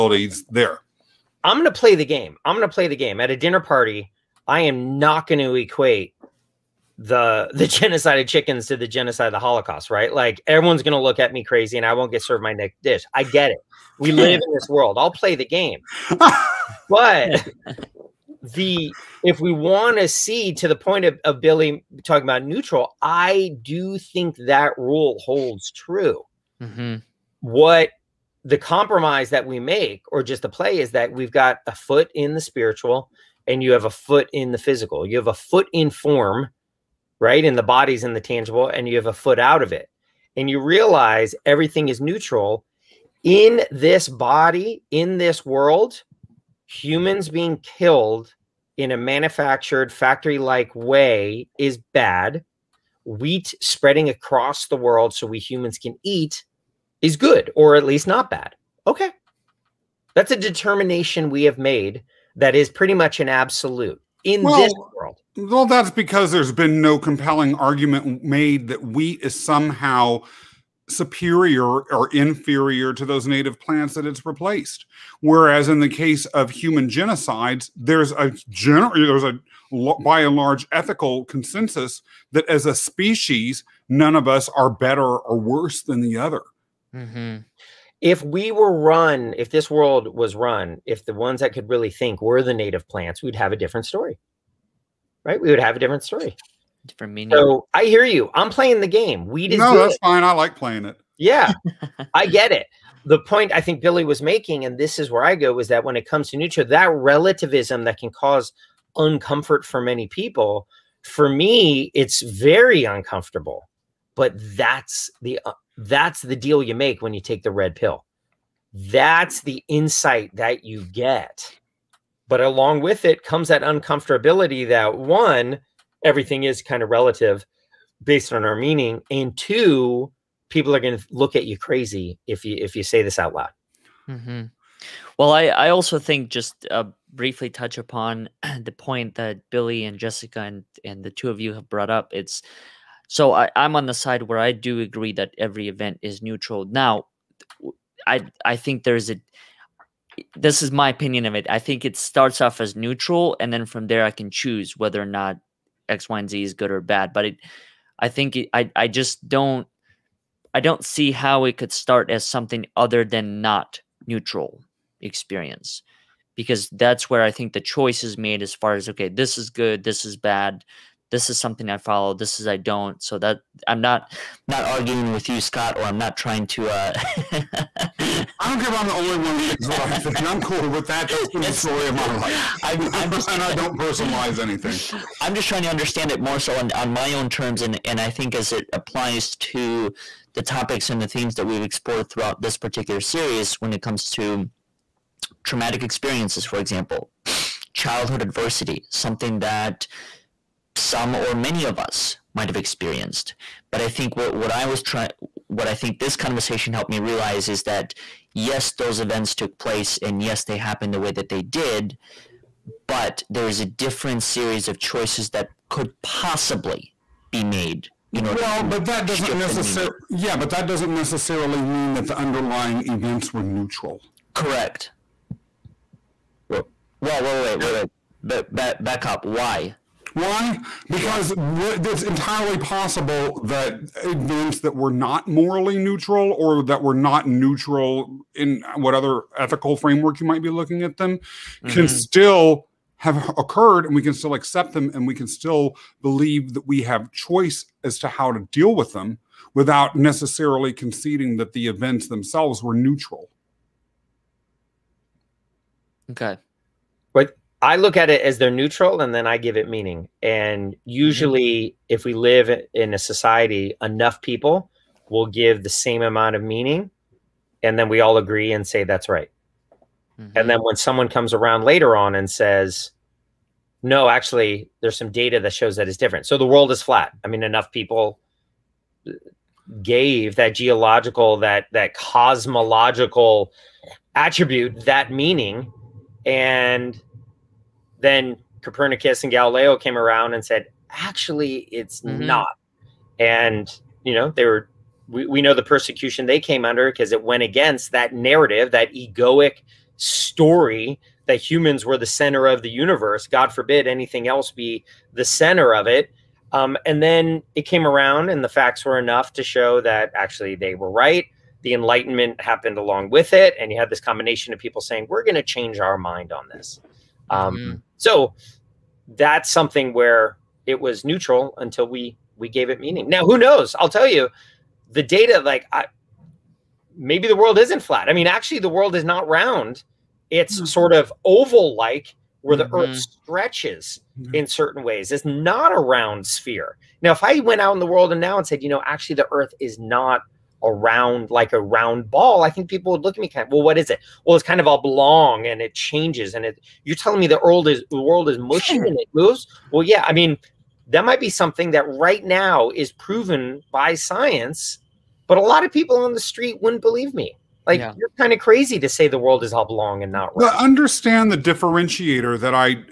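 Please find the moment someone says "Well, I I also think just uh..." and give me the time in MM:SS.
02:15.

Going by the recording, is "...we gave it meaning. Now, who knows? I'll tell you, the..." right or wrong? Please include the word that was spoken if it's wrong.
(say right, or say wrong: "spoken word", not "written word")
right.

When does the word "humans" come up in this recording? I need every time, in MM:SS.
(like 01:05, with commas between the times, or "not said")
00:46, 00:55, 01:16, 05:01.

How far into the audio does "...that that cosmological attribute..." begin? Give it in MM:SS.
04:41.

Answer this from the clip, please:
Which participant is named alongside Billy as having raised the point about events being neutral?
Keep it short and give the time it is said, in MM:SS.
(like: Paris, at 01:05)
Jessica, at 02:19.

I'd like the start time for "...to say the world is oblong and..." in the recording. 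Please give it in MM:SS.
05:58.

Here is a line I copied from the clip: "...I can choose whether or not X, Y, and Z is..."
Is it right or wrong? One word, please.
right.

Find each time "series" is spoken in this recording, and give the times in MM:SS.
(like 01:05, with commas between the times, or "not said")
03:13, 03:34.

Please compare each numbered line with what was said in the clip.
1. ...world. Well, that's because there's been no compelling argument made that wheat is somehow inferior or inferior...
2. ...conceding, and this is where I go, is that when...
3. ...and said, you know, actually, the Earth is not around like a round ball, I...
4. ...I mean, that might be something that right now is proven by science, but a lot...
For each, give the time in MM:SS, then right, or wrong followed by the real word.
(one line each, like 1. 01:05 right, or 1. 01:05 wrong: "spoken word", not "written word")
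1. 01:04 wrong: "superior", not "inferior"
2. 01:44 wrong: "making", not "conceding"
3. 05:38 right
4. 05:50 right.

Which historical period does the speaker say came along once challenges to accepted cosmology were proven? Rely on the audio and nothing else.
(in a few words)
The Enlightenment.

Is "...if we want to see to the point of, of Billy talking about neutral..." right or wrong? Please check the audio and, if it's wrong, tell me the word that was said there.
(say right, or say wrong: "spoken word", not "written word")
right.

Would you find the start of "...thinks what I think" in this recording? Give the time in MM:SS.
02:59.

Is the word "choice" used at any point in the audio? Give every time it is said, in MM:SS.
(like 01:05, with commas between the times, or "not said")
02:47, 03:34, 04:07.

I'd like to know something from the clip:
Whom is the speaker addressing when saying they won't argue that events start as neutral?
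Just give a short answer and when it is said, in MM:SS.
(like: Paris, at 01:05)
Scott, at 02:55.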